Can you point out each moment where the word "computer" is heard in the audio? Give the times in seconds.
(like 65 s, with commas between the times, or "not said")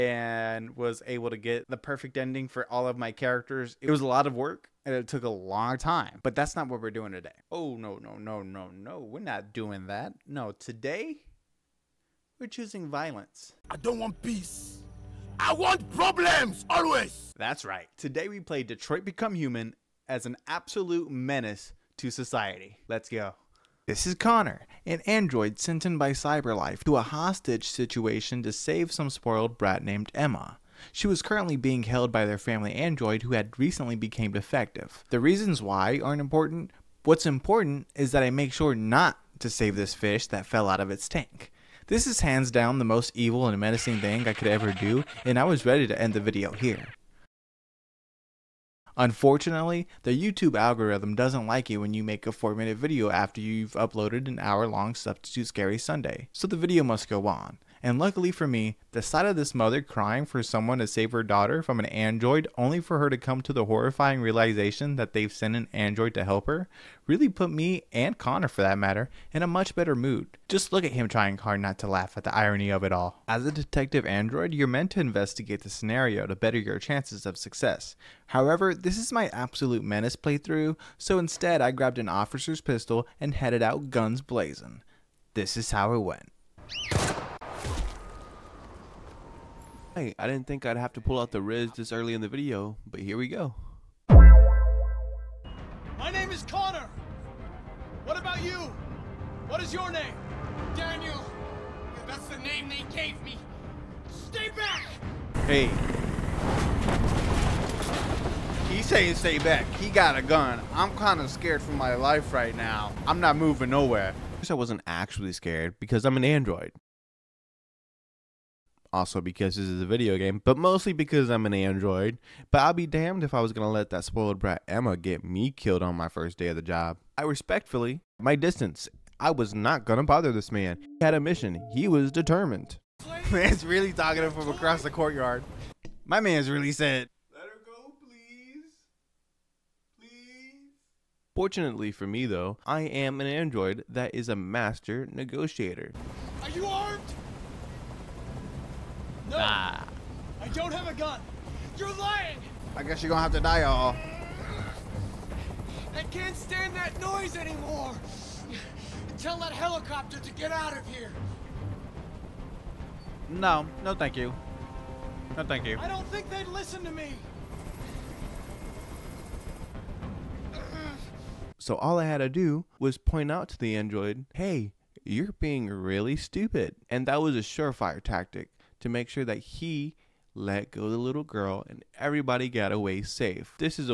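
not said.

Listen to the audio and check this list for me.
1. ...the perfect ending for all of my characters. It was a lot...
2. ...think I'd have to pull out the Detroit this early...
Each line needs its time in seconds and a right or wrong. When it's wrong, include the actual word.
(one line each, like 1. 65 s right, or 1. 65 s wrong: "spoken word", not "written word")
1. 1 s right
2. 90 s wrong: "Riz", not "Detroit".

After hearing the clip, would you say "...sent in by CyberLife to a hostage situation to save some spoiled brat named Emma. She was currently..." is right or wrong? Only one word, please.
right.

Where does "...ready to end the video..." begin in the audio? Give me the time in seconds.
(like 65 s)
45 s.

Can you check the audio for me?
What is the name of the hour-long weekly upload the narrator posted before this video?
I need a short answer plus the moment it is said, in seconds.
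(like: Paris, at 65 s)
Substitute Scary Sunday, at 54 s.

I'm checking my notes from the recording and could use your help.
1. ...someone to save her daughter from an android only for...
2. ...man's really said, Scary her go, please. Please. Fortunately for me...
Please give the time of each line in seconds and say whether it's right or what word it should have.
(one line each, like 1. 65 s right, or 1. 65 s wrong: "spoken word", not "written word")
1. 60 s right
2. 136 s wrong: "Let", not "Scary".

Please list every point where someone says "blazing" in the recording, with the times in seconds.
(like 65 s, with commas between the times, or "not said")
84 s.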